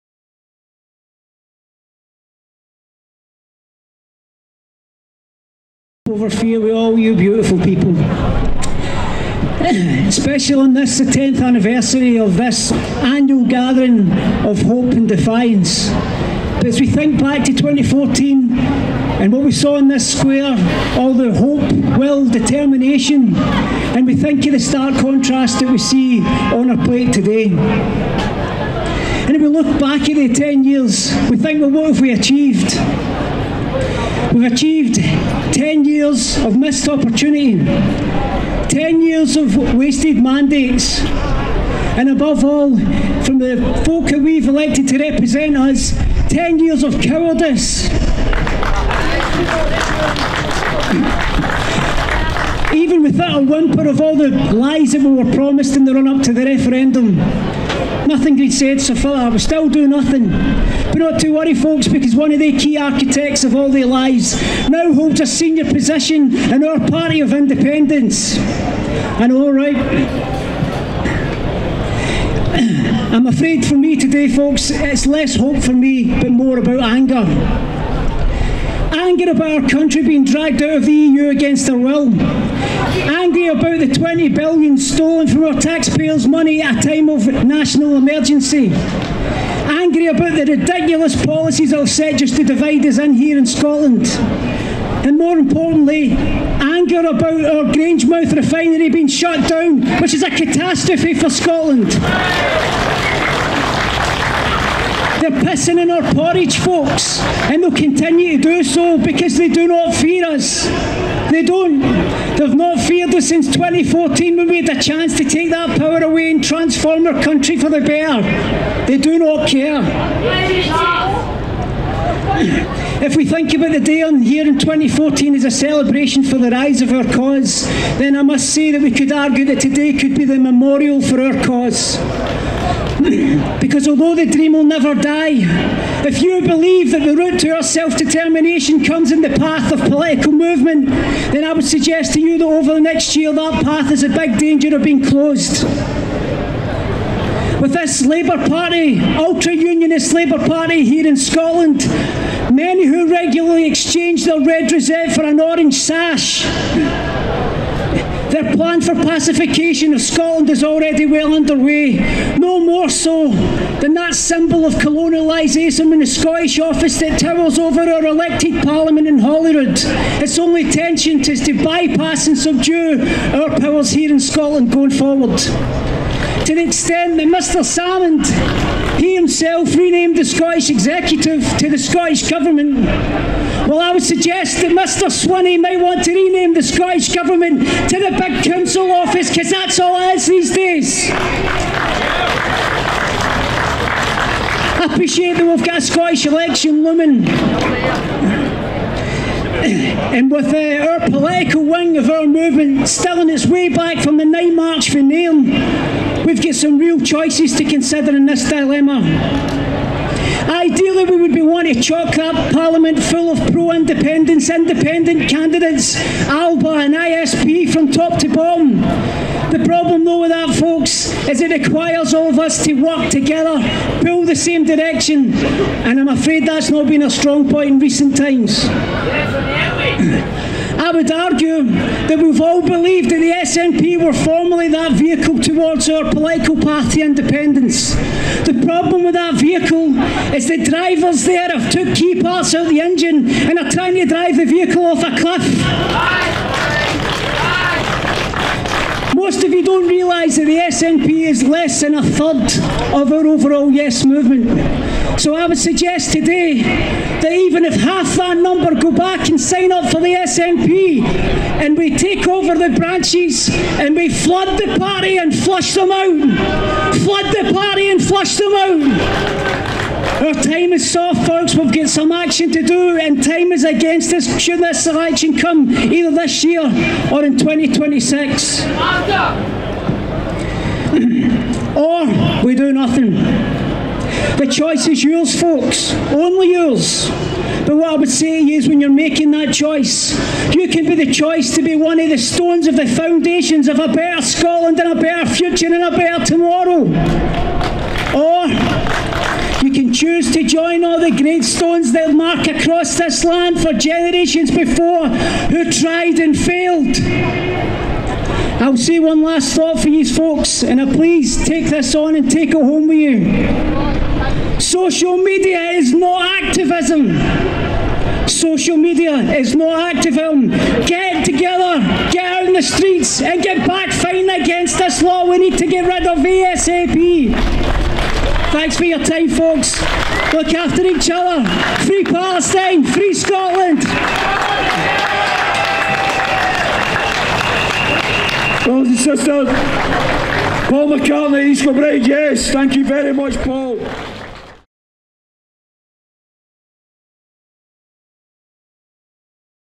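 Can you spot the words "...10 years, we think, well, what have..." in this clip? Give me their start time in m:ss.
0:30.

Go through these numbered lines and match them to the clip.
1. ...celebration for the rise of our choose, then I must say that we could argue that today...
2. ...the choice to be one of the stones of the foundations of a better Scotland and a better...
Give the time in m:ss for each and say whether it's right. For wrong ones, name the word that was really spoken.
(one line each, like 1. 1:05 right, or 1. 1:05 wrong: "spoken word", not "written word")
1. 2:05 wrong: "cause", not "choose"
2. 4:50 right.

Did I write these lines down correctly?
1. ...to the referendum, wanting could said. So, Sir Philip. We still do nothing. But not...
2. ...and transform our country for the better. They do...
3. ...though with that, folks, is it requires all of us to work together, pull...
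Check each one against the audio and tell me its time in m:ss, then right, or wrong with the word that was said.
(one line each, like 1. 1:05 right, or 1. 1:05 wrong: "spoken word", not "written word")
1. 0:56 wrong: "nothing", not "wanting"
2. 1:56 right
3. 3:40 right.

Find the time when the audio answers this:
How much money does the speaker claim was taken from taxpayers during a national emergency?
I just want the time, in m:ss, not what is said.
1:23.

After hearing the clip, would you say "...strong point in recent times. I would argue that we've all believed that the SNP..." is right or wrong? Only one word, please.
right.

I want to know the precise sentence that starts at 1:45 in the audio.
They're pissing in our porridge, folks, and they'll continue to do so because they do not fear us.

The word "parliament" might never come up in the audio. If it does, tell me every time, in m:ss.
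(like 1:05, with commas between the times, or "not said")
2:48, 3:32.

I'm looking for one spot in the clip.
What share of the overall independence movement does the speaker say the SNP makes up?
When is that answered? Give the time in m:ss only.
4:11.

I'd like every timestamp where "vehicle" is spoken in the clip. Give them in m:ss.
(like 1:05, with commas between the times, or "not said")
3:54, 3:59, 4:04.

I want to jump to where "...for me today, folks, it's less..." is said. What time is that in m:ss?
1:13.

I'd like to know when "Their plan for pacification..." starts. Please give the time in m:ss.
2:38.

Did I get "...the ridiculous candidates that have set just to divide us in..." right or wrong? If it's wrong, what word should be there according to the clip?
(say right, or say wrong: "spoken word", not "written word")
wrong: "policies", not "candidates".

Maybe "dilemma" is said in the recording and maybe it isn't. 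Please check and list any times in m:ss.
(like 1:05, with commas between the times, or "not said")
3:28.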